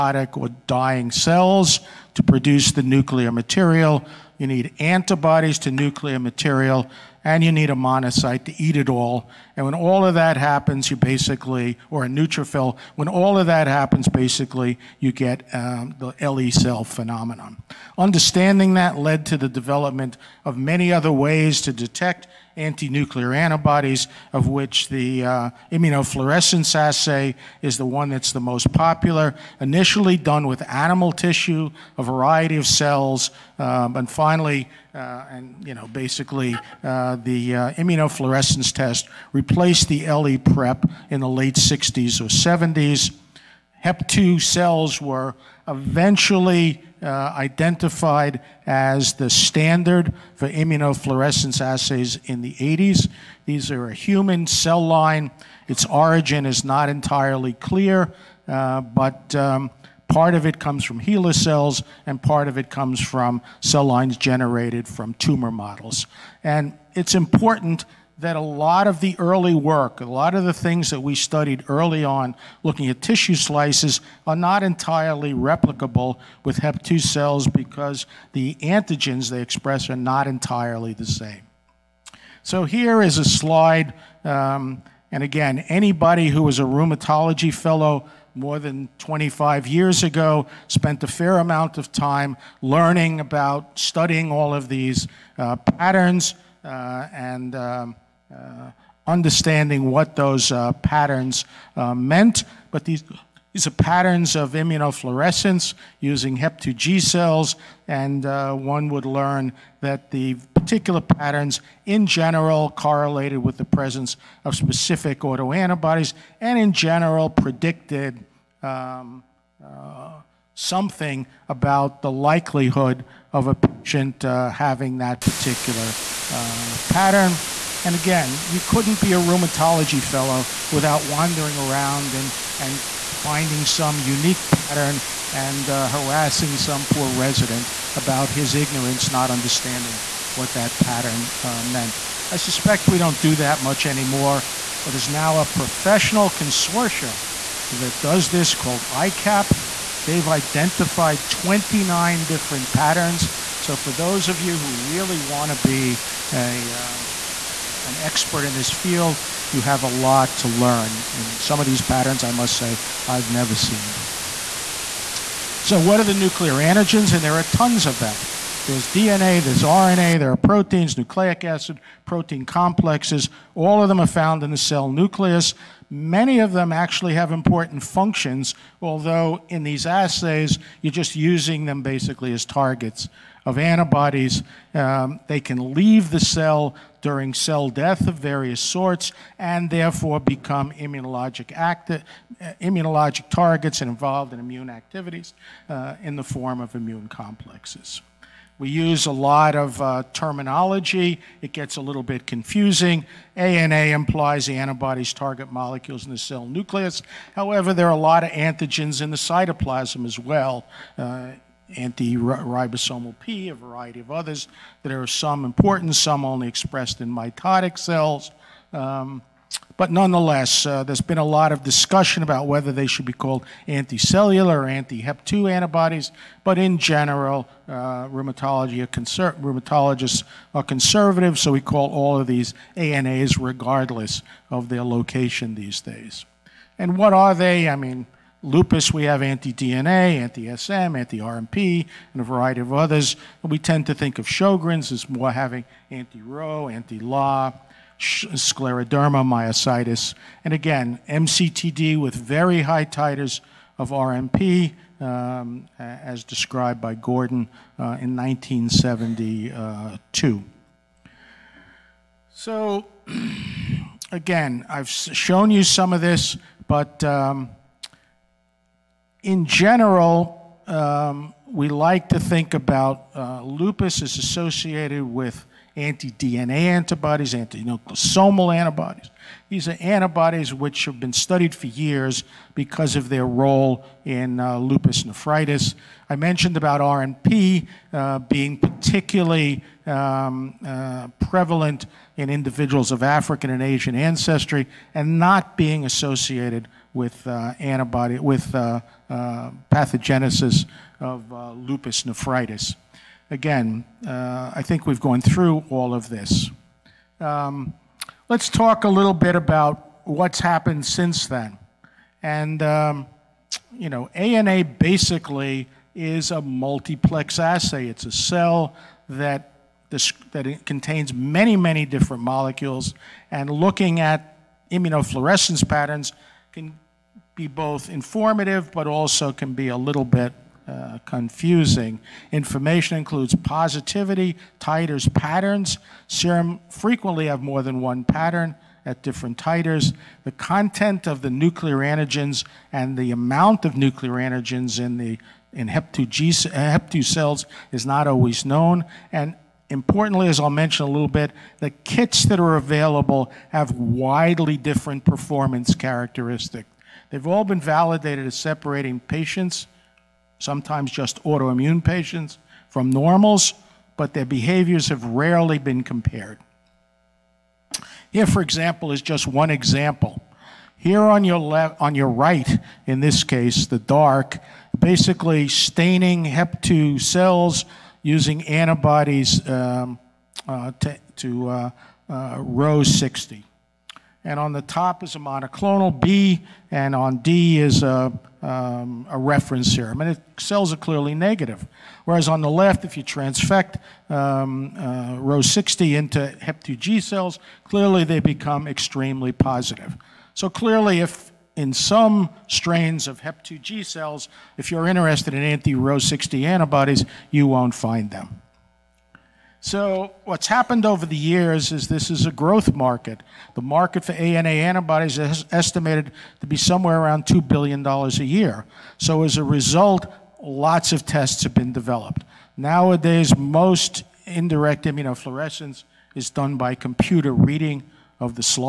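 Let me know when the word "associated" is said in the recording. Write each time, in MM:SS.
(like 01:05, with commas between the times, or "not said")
04:34, 04:55.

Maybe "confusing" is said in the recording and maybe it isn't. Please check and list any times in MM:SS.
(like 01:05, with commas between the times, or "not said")
03:22, 05:31.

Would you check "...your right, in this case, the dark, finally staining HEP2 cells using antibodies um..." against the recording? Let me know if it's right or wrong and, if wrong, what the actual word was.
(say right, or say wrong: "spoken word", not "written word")
wrong: "basically", not "finally".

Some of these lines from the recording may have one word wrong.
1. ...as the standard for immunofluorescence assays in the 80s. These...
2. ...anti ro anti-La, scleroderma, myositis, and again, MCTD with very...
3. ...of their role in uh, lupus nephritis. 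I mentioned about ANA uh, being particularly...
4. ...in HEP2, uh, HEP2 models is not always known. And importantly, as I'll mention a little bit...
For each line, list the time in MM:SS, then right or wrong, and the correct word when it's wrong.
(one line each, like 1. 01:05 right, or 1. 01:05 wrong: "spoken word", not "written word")
1. 00:48 right
2. 04:05 right
3. 04:42 wrong: "RNP", not "ANA"
4. 05:45 wrong: "cells", not "models".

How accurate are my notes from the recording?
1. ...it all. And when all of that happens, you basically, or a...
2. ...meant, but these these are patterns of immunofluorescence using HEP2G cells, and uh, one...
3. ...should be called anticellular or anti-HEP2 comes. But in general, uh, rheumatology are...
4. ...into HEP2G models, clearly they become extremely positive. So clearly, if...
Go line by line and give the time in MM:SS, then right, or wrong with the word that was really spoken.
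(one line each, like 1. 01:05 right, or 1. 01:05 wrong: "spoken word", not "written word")
1. 00:08 right
2. 01:41 right
3. 03:42 wrong: "antibodies", not "comes"
4. 06:35 wrong: "cells", not "models".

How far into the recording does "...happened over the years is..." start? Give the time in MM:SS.
06:50.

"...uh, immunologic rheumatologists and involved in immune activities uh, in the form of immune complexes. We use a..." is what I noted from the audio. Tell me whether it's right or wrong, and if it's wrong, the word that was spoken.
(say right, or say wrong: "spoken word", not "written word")
wrong: "targets", not "rheumatologists".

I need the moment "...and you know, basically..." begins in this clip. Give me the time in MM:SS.
00:35.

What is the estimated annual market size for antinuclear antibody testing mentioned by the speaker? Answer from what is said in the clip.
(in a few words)
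$2 billion.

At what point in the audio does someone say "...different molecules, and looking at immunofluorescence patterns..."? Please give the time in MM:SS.
05:21.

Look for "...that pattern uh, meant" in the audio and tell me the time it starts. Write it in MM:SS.
02:20.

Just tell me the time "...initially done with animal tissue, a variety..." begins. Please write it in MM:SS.
00:29.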